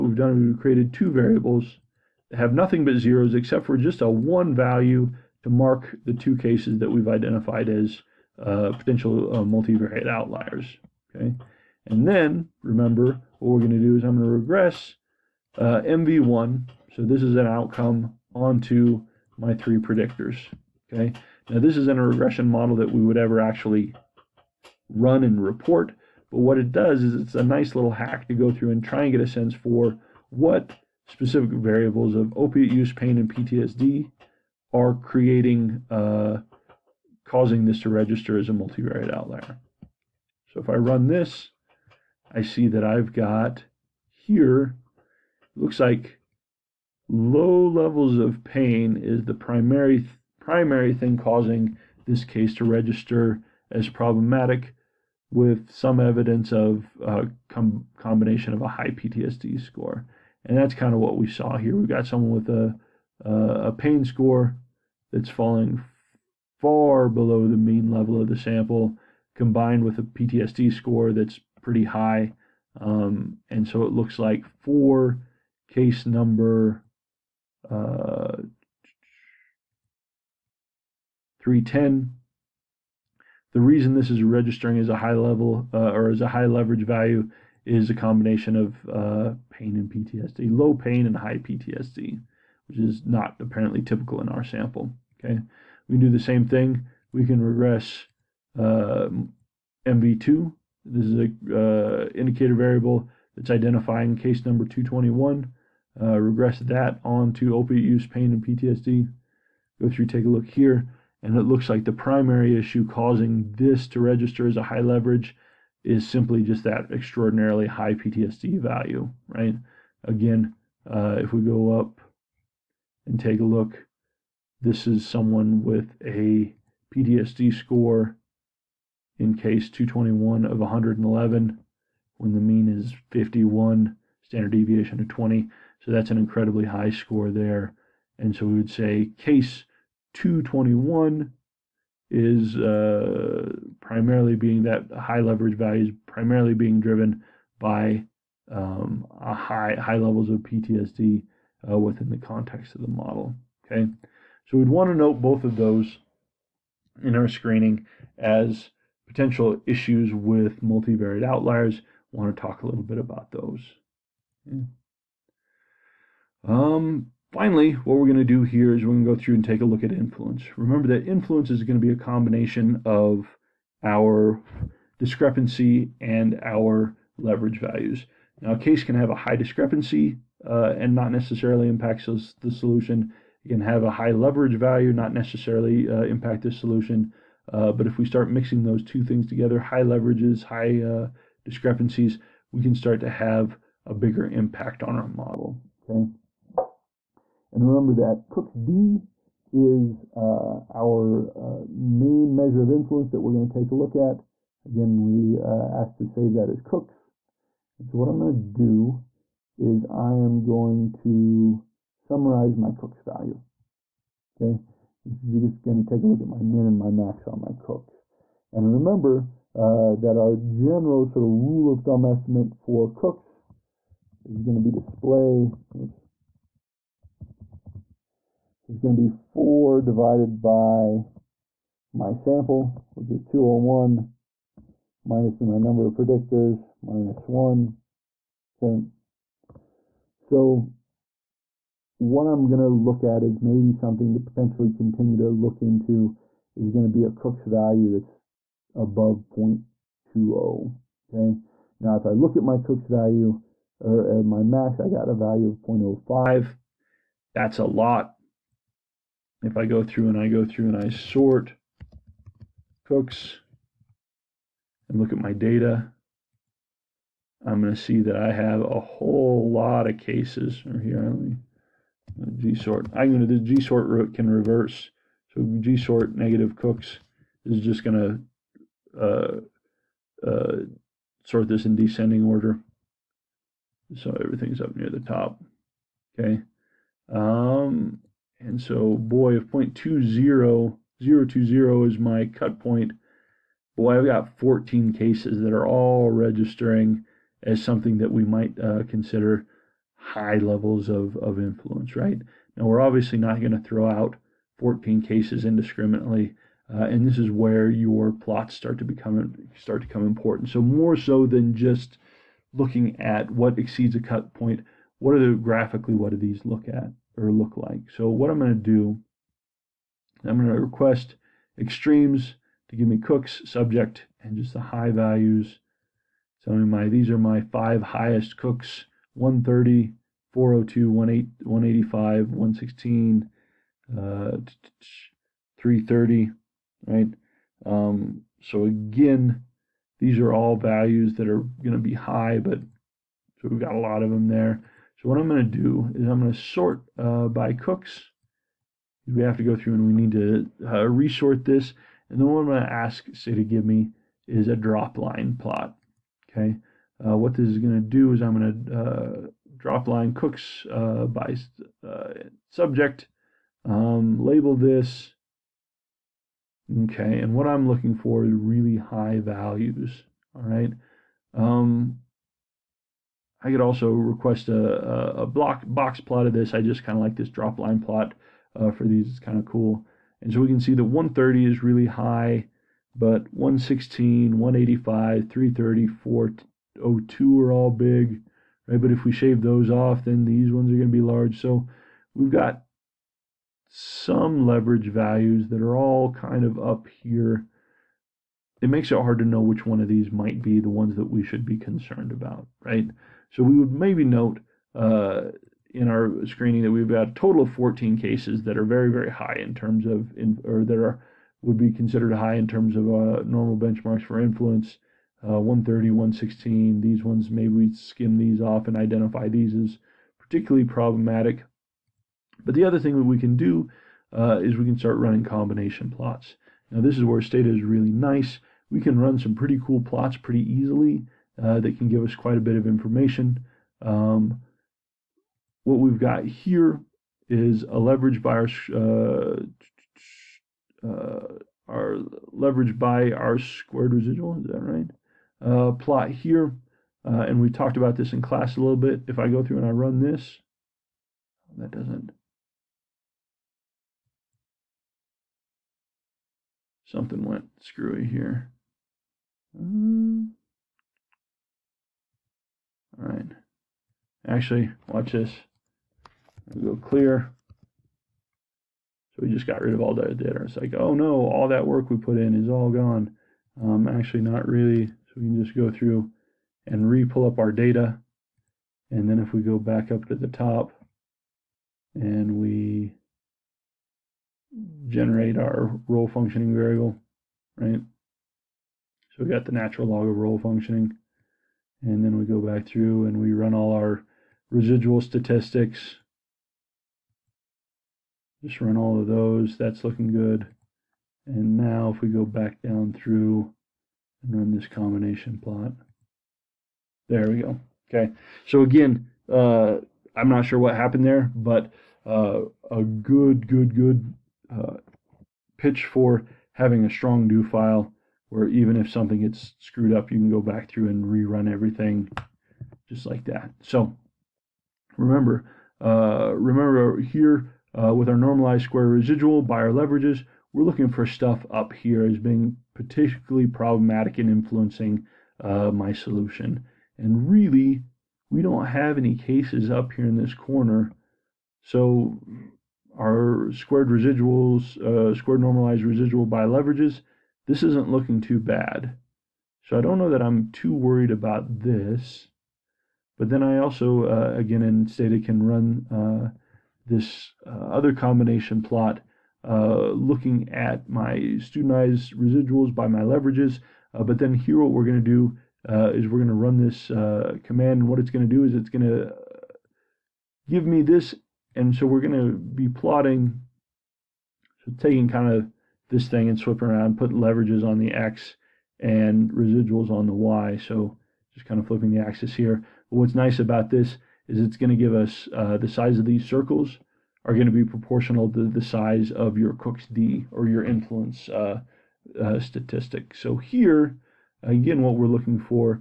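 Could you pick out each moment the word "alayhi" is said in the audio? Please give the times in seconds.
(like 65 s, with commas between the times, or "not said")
not said.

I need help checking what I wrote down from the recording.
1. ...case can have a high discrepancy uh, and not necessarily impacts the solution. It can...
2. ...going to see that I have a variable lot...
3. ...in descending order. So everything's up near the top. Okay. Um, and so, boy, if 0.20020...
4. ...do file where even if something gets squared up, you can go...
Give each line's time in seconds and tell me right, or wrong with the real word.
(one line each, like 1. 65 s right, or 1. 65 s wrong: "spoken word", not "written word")
1. 178 s right
2. 267 s wrong: "whole", not "variable"
3. 281 s right
4. 517 s wrong: "screwed", not "squared".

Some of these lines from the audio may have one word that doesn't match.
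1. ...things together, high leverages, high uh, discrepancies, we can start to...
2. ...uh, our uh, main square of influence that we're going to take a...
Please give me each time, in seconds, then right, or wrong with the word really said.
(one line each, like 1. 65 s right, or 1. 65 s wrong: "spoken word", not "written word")
1. 189 s right
2. 200 s wrong: "measure", not "square".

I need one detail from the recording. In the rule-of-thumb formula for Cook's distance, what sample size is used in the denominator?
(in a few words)
201.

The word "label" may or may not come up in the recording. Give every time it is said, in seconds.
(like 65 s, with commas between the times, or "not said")
364 s.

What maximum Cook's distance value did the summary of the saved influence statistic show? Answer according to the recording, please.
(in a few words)
0.05.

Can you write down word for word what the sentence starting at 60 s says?
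And that's kind of what we saw here.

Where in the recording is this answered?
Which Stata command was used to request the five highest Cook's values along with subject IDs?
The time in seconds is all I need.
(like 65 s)
321 s.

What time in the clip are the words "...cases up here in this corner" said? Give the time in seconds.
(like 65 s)
539 s.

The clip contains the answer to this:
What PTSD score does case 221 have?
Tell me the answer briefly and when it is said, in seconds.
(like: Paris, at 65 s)
111, at 130 s.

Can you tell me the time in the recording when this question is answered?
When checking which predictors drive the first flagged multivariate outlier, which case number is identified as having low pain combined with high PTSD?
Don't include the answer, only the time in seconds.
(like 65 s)
81 s.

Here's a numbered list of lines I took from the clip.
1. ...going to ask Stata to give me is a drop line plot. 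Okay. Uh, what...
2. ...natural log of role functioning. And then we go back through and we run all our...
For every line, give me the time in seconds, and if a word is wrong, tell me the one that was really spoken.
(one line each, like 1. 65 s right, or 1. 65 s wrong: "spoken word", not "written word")
1. 352 s right
2. 489 s right.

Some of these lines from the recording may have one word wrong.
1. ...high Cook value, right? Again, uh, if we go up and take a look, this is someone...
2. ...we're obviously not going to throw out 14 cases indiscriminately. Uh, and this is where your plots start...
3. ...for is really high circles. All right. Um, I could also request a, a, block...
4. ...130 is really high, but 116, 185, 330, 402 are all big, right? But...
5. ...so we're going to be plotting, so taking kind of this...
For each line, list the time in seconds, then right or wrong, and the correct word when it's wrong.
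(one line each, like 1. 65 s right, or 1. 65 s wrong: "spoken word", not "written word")
1. 117 s wrong: "PTSD", not "Cook"
2. 302 s right
3. 367 s wrong: "values", not "circles"
4. 380 s right
5. 571 s right.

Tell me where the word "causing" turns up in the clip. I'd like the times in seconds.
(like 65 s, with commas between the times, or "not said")
37 s, 51 s, 112 s.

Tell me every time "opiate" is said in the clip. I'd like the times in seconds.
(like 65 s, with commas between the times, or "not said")
32 s, 107 s.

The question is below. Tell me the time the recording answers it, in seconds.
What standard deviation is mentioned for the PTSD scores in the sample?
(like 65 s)
134 s.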